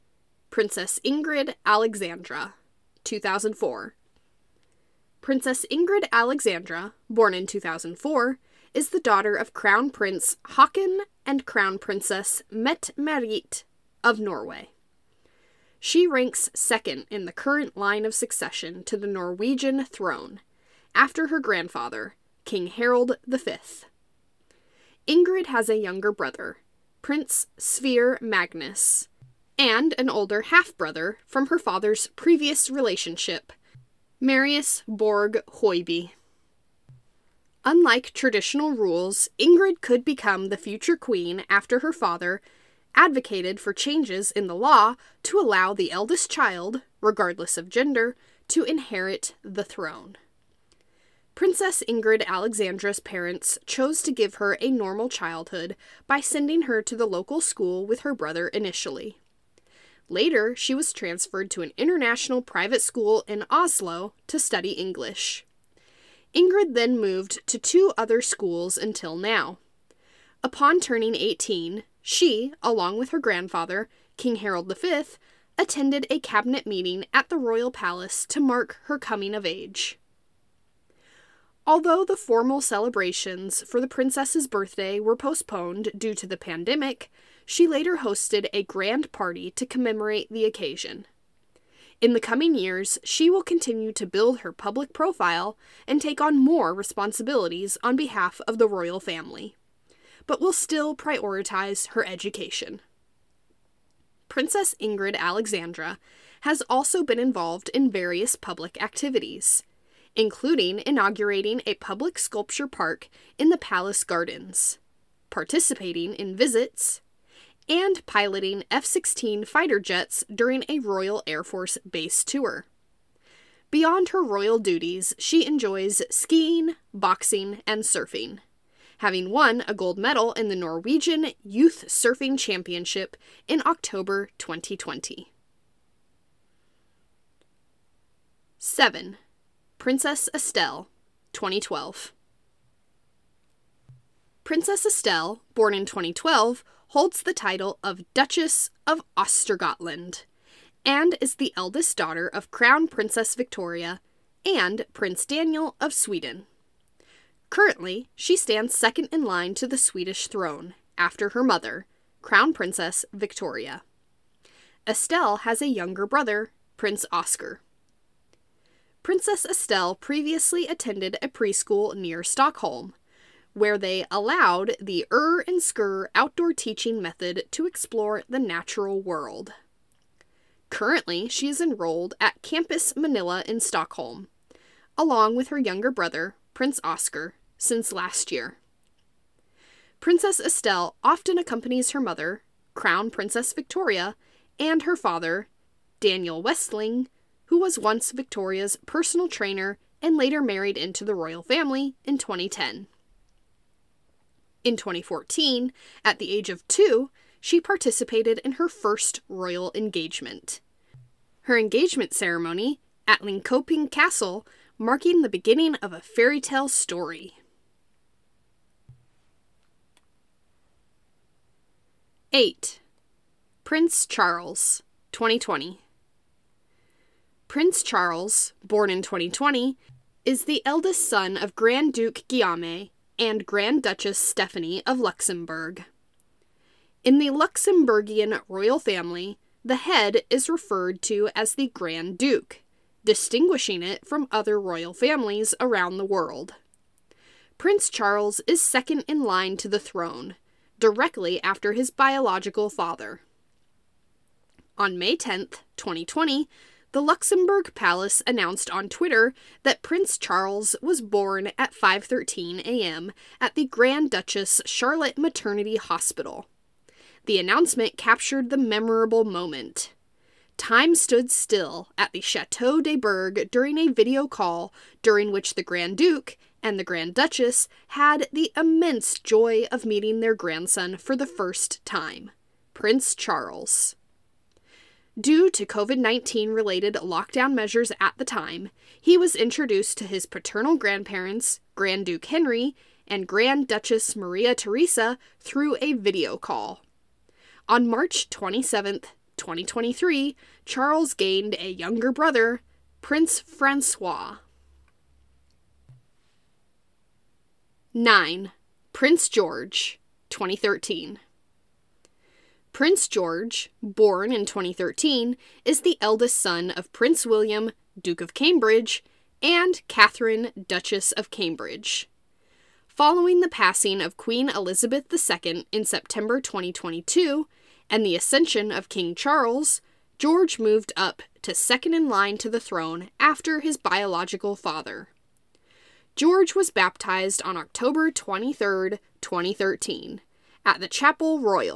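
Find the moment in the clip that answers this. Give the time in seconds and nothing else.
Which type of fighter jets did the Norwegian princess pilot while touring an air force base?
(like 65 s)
118 s.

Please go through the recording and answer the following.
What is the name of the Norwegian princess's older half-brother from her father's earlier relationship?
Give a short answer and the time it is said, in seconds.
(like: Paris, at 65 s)
Marius Borg Hoiby, at 34 s.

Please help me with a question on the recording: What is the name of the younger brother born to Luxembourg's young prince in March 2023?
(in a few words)
Prince Francois.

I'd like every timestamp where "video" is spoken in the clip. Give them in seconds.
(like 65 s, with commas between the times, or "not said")
273 s, 295 s.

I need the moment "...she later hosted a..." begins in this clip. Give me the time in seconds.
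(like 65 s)
87 s.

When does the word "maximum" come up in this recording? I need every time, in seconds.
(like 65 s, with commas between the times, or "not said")
not said.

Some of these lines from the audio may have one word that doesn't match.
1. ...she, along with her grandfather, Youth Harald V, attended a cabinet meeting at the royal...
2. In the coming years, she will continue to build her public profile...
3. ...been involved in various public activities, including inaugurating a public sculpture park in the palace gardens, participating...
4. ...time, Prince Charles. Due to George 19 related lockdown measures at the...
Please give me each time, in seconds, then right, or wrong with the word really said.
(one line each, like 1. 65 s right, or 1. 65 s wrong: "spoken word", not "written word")
1. 72 s wrong: "King", not "Youth"
2. 92 s right
3. 107 s right
4. 281 s wrong: "COVID", not "George".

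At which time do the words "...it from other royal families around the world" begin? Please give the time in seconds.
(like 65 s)
243 s.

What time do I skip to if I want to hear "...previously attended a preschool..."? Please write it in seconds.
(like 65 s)
169 s.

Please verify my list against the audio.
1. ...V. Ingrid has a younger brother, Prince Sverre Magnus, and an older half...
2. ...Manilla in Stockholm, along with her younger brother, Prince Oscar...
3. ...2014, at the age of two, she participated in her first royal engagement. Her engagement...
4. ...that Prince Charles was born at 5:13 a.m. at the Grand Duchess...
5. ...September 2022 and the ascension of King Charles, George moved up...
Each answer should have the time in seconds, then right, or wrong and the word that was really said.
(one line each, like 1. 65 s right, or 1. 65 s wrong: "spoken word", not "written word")
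1. 23 s right
2. 182 s right
3. 204 s right
4. 259 s right
5. 325 s right.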